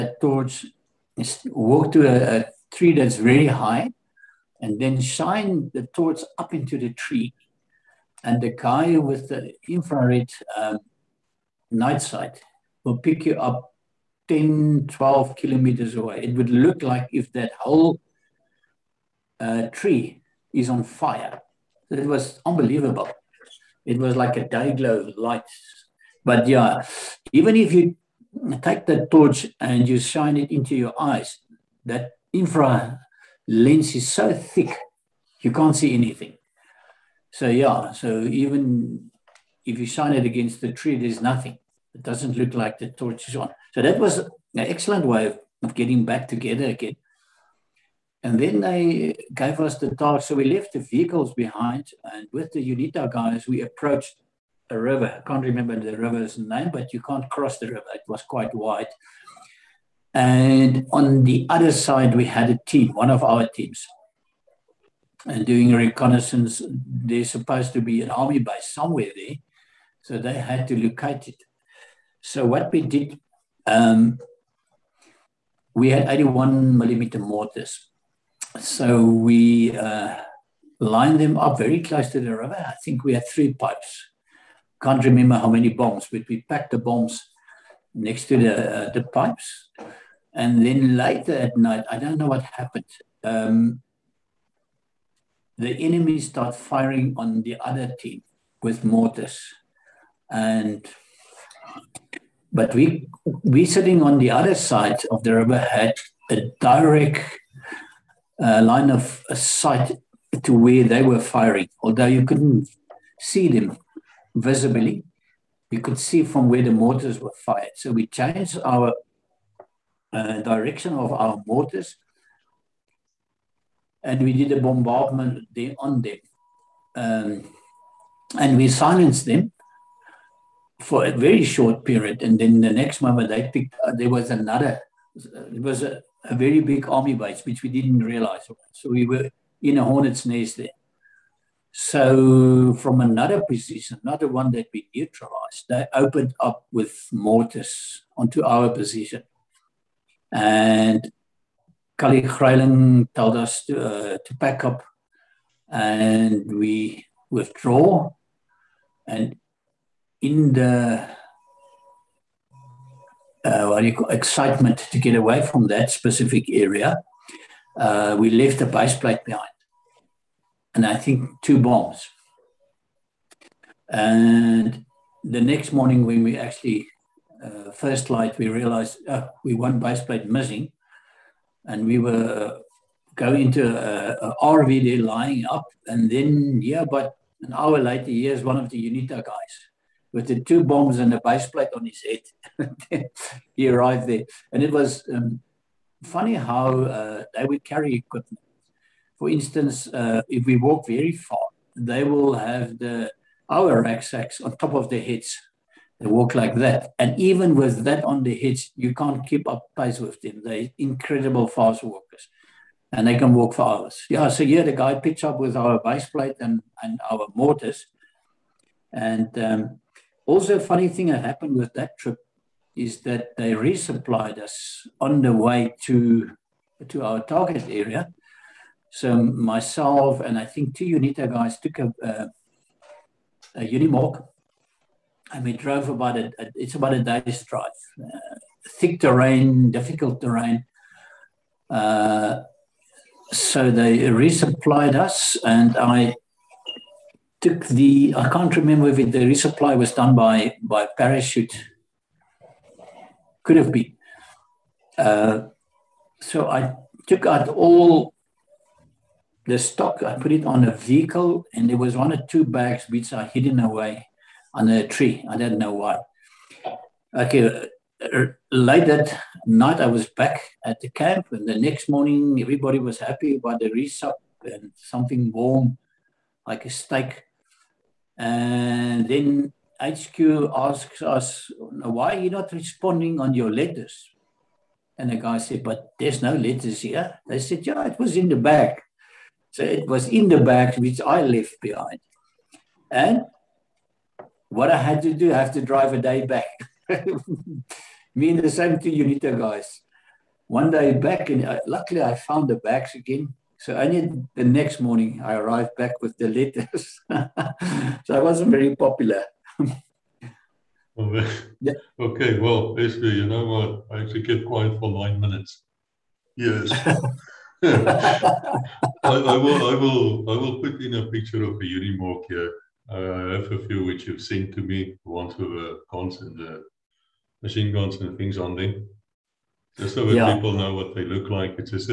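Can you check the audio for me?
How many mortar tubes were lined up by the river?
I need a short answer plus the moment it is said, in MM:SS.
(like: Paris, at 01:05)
3, at 01:23.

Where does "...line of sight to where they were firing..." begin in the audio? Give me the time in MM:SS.
01:48.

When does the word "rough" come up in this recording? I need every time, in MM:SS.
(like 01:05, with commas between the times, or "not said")
not said.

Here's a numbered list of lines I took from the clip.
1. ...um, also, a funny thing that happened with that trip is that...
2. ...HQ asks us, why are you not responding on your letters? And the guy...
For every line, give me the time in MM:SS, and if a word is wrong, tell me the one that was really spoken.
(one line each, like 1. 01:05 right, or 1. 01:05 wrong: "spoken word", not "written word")
1. 03:39 right
2. 04:39 right.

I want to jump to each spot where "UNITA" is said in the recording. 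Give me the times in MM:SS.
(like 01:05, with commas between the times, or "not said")
00:52, 03:08, 03:50, 04:58.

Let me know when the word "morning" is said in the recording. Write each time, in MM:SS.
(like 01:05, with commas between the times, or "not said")
02:55, 04:31, 05:04.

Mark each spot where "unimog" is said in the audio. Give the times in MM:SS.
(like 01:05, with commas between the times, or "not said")
03:53, 05:21.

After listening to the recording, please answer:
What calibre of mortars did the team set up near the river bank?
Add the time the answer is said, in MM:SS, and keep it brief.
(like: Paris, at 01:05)
81 millimeter, at 01:16.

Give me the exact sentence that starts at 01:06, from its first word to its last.
There's supposed to be an army base somewhere there.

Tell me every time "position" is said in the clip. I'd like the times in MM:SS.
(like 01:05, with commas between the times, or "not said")
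02:23, 02:28.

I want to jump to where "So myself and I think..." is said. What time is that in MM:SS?
03:48.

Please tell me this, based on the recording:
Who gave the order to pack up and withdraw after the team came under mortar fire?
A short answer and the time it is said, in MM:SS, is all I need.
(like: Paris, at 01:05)
Kali Greiling, at 02:31.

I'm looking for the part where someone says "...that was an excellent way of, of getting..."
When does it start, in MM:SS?
00:43.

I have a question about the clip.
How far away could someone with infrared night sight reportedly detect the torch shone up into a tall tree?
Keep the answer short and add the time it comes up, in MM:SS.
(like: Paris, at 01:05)
10 to 12 kilometers, at 00:14.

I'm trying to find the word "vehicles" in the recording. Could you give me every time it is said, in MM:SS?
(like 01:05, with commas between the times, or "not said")
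00:50, 04:20.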